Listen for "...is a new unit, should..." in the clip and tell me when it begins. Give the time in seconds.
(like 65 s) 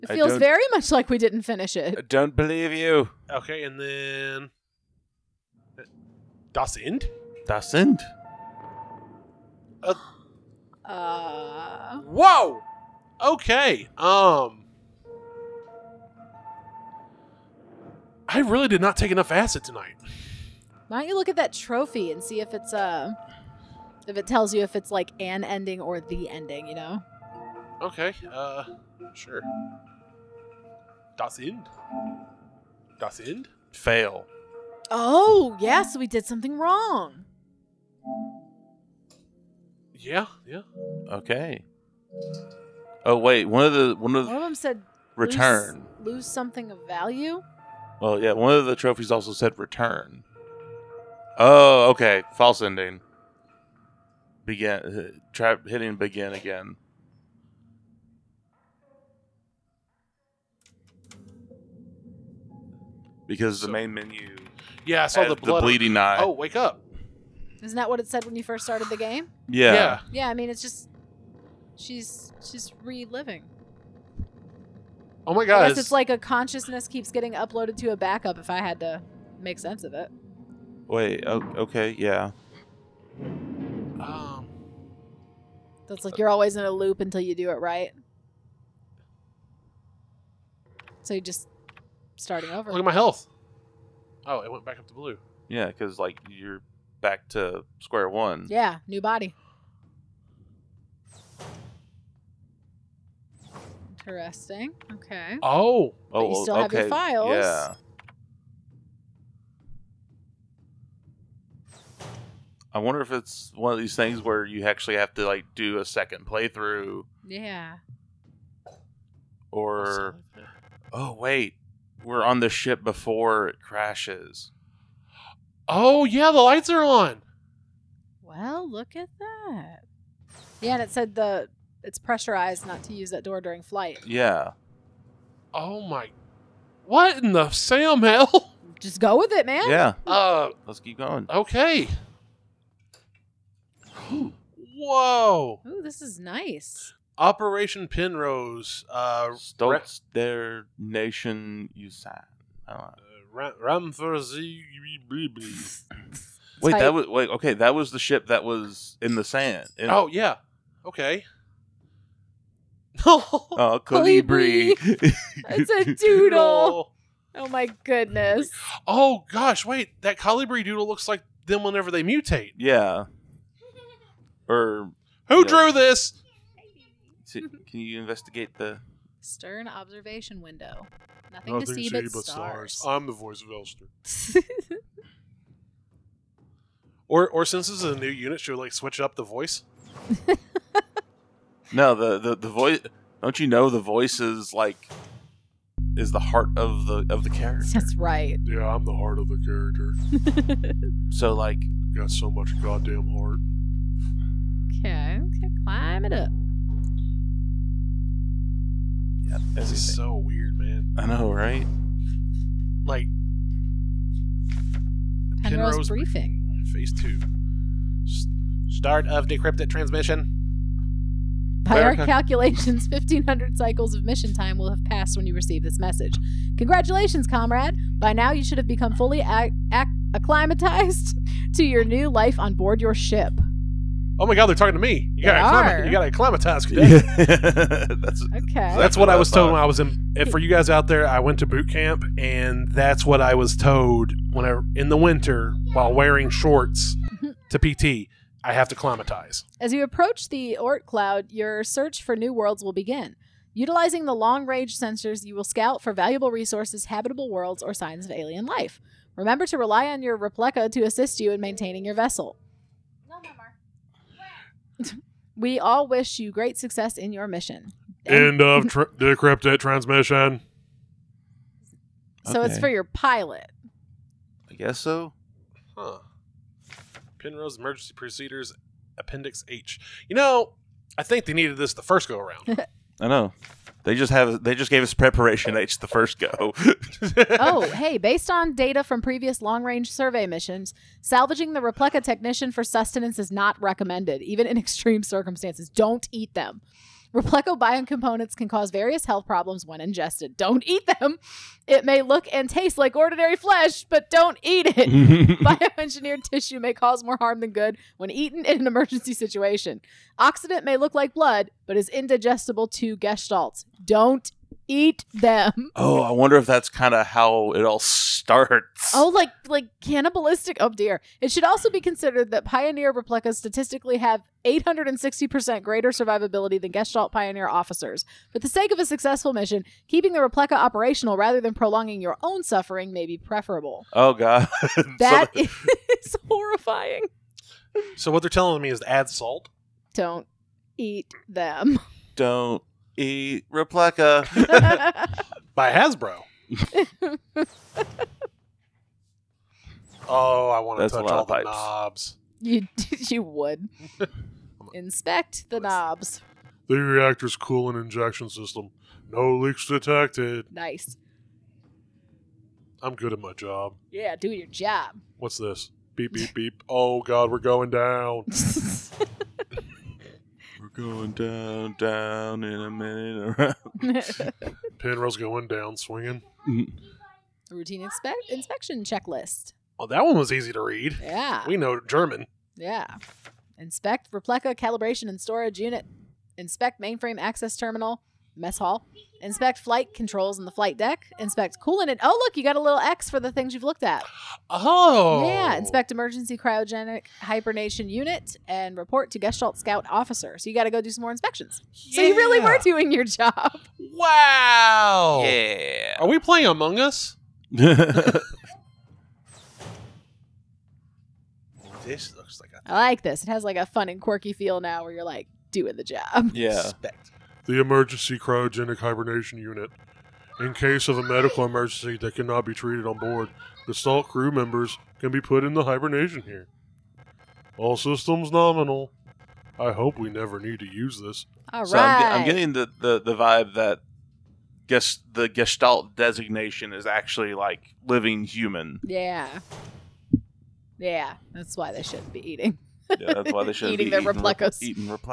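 187 s.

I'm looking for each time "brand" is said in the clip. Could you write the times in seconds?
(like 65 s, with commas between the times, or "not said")
not said.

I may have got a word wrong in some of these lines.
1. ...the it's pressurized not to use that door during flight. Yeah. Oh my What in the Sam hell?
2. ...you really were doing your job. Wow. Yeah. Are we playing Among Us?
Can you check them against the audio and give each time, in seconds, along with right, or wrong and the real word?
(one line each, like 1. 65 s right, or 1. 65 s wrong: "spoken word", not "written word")
1. 131 s right
2. 402 s right.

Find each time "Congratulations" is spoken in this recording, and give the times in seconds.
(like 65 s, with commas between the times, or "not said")
226 s.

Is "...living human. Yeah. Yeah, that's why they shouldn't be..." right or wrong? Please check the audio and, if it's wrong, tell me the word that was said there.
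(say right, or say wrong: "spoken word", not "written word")
right.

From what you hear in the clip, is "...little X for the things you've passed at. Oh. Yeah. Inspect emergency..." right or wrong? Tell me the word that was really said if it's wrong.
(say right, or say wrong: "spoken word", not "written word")
wrong: "looked", not "passed".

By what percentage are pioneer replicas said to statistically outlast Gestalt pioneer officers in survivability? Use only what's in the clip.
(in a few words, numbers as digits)
860%.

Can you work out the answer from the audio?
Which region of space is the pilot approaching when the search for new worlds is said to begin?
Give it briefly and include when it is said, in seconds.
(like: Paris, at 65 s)
Oort cloud, at 250 s.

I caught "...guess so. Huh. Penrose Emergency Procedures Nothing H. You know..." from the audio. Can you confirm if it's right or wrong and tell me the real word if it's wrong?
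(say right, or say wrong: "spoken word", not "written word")
wrong: "Appendix", not "Nothing".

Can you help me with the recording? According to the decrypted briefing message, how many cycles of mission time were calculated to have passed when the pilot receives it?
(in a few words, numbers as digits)
1,500.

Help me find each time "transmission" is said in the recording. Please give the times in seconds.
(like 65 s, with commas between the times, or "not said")
219 s, 269 s.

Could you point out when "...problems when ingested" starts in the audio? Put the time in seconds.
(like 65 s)
299 s.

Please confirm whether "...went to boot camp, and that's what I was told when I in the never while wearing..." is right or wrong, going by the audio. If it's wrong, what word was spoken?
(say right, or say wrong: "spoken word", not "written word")
wrong: "winter", not "never".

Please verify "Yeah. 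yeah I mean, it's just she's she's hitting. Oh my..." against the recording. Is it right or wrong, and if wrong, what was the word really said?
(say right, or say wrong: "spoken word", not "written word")
wrong: "reliving", not "hitting".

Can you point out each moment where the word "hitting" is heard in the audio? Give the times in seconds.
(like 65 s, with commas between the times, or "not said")
55 s.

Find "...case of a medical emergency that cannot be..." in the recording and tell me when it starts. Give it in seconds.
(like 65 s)
420 s.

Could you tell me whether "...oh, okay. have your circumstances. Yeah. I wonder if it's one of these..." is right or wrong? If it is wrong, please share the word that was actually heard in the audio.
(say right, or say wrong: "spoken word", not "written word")
wrong: "files", not "circumstances".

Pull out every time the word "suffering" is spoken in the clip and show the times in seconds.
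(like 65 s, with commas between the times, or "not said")
332 s.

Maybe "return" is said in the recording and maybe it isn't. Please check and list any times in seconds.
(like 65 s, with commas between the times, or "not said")
45 s, 49 s.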